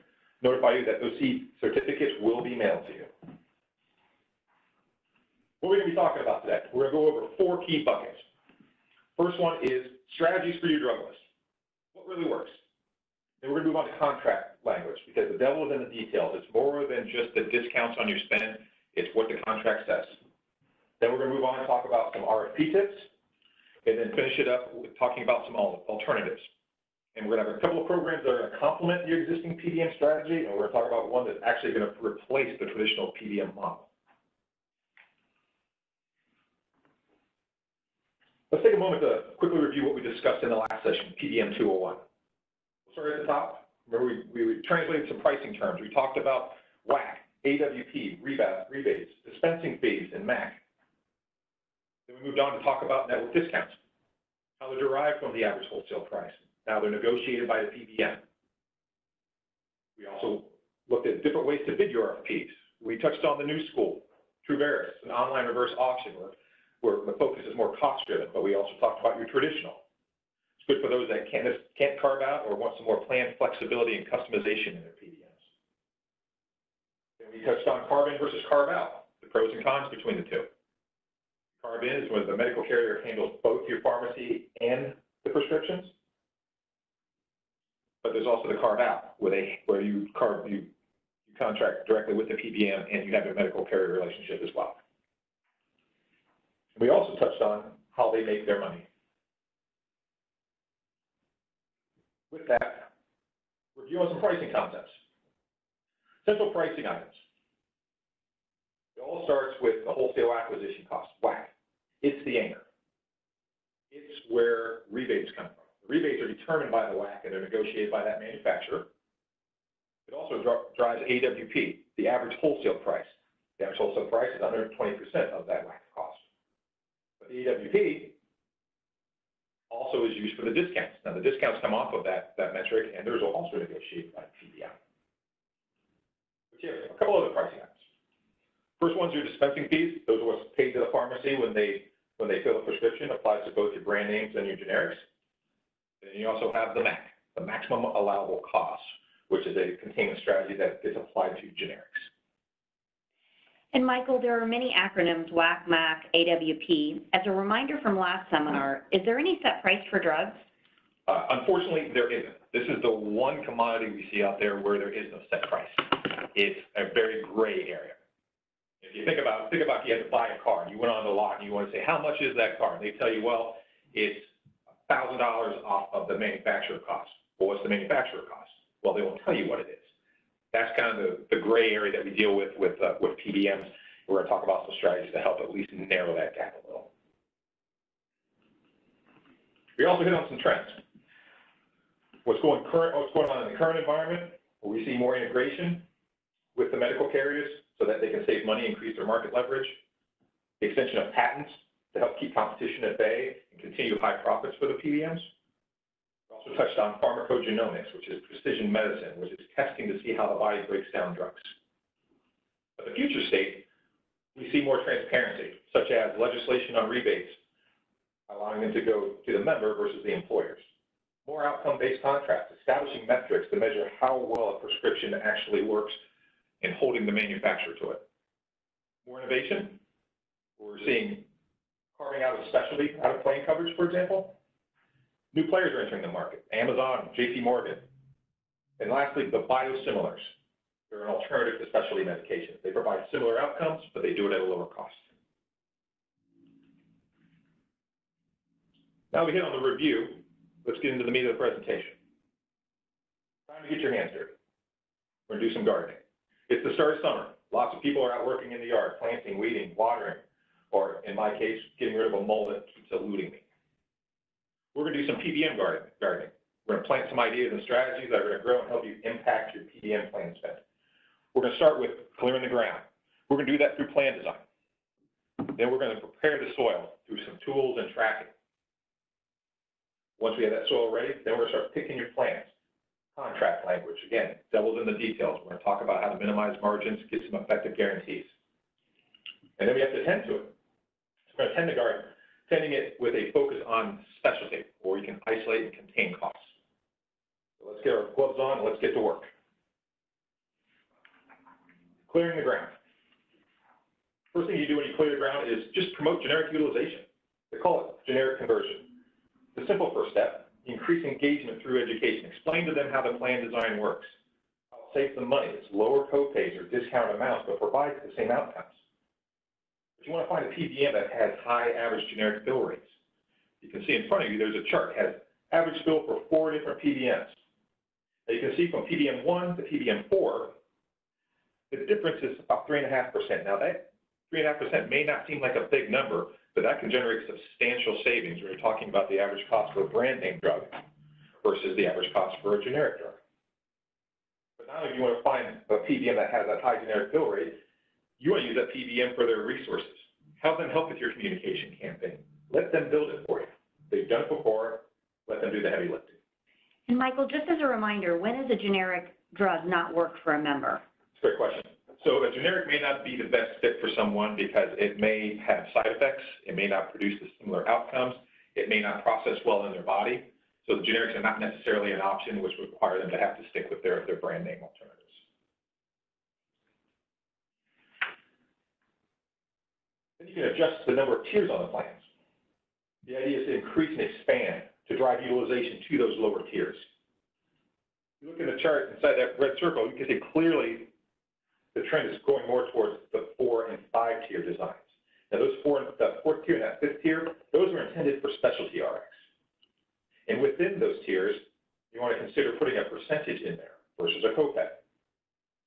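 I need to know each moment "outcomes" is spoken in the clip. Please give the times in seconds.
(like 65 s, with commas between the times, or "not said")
221 s, 243 s, 318 s, 367 s.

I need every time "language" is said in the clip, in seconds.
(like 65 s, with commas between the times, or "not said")
14 s, 283 s.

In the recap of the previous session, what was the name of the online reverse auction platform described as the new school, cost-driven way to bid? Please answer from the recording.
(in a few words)
Truveris.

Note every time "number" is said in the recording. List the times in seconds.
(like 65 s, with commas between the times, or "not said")
335 s, 380 s.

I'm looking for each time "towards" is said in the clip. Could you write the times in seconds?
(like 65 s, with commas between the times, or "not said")
392 s.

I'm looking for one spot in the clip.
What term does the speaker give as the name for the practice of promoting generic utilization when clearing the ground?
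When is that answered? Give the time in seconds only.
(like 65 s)
308 s.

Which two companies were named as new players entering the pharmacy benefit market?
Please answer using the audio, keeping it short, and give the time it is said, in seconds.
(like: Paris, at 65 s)
Amazon, J.P. Morgan, at 236 s.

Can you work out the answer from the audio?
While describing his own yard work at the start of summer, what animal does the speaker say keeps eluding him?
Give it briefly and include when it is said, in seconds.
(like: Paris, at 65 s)
A mole, at 262 s.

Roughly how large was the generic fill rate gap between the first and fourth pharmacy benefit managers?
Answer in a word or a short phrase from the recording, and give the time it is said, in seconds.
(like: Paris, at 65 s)
About 3.5%, at 332 s.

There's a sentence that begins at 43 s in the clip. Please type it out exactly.
Remember, we, we translated some pricing terms.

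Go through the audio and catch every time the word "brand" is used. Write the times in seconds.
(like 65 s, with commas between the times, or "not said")
143 s, 339 s, 374 s.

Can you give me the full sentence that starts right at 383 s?
The idea is to increase and expand to drive utilization to those lower tiers.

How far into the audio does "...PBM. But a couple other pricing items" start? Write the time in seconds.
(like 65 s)
134 s.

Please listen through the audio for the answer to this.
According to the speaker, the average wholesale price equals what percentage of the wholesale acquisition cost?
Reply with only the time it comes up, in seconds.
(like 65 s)
124 s.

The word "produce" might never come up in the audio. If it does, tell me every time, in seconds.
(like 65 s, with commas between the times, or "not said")
366 s.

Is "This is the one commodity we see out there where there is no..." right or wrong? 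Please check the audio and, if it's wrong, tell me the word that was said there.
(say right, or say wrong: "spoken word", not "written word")
right.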